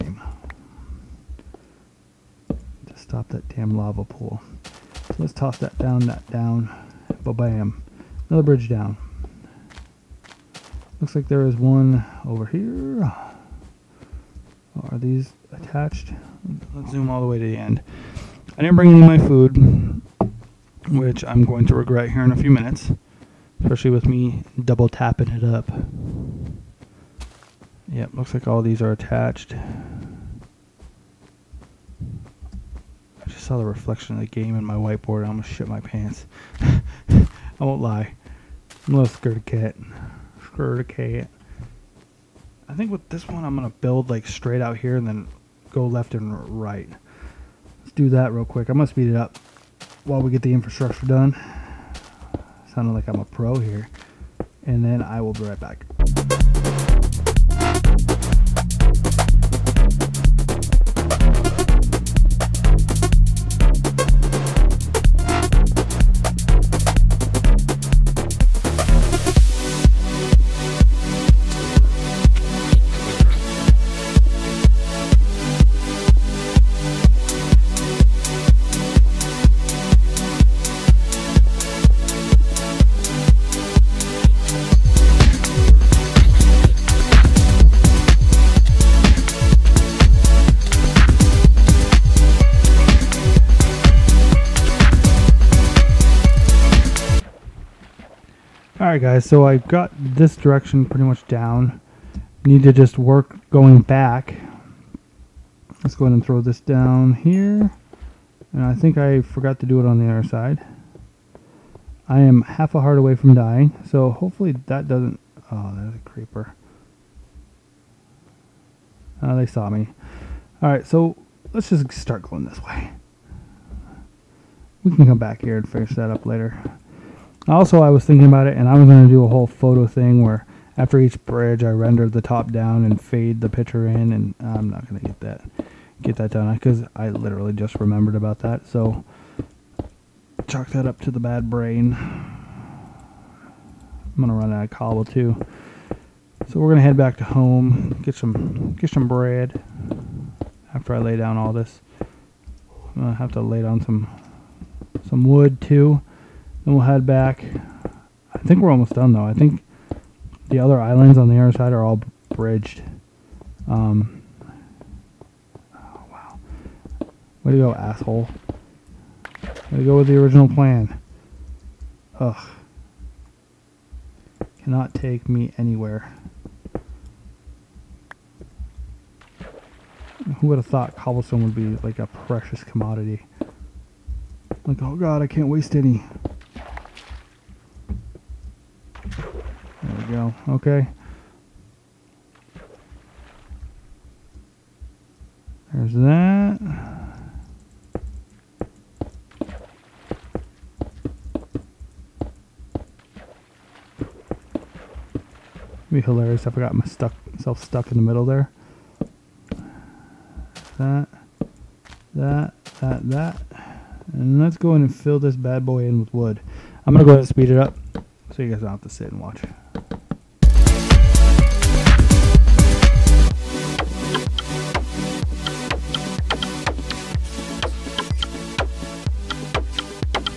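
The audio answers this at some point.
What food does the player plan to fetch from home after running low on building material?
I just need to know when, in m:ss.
2:29.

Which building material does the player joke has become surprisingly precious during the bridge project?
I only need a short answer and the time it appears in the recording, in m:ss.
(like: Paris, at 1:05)
cobblestone, at 3:00.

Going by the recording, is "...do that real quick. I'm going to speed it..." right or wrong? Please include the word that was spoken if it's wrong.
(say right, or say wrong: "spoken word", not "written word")
right.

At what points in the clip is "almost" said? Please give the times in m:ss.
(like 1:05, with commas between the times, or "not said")
0:35, 2:38.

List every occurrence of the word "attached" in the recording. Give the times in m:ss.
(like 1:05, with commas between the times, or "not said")
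0:15, 0:28.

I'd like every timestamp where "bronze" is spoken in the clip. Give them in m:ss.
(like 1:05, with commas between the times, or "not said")
not said.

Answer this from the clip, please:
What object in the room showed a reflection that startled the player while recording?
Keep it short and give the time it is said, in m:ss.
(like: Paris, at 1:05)
whiteboard, at 0:34.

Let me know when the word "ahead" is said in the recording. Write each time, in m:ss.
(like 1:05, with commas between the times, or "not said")
1:46, 3:37.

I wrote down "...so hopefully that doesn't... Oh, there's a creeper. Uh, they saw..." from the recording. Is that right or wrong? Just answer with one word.
right.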